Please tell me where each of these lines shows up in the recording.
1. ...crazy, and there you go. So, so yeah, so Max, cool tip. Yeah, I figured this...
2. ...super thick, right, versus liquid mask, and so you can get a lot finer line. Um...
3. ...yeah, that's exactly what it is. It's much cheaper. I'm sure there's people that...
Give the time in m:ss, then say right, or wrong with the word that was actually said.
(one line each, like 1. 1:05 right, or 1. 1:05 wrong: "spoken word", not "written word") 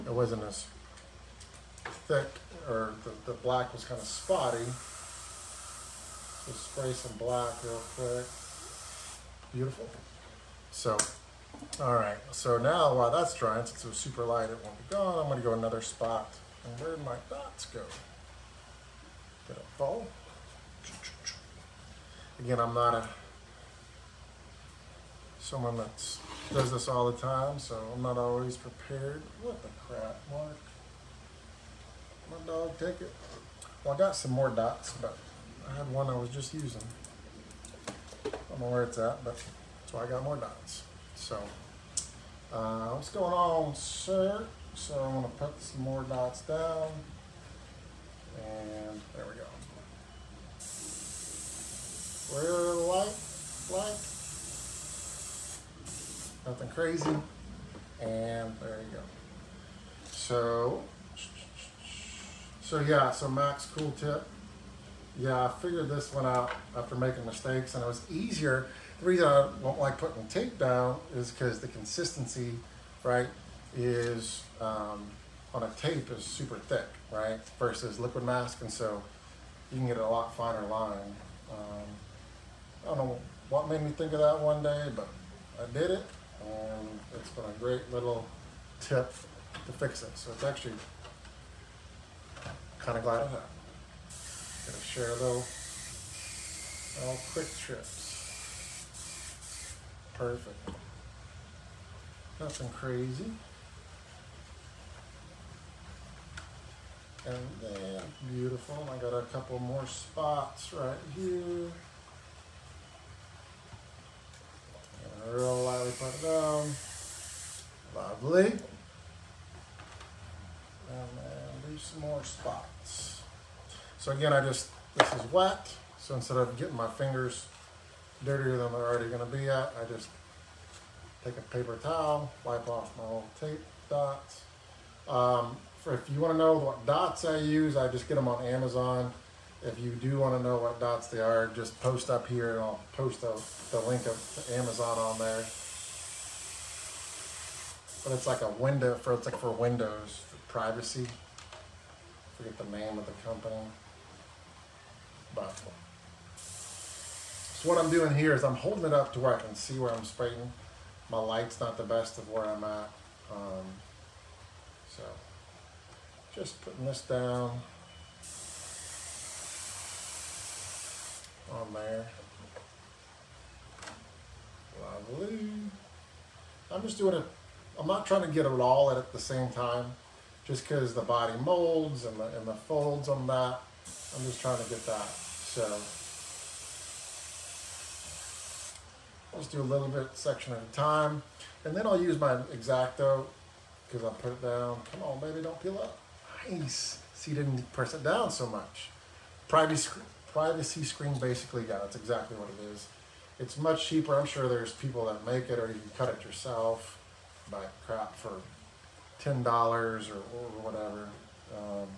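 1. 0:56 right
2. 1:16 right
3. 3:21 right.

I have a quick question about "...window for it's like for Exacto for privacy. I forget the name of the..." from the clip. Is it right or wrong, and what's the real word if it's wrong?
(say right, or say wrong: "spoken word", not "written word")
wrong: "Windows", not "Exacto".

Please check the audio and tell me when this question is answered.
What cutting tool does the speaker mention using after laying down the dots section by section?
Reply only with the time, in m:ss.
3:12.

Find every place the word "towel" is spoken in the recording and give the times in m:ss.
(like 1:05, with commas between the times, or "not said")
2:11.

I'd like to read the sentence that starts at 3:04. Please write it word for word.
I'm just trying to get that.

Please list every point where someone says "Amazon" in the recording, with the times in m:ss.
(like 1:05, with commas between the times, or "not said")
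2:18, 2:24.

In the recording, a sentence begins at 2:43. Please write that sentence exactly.
Um, so just putting this down.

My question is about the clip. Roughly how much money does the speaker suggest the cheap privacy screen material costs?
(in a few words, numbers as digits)
10 dollars.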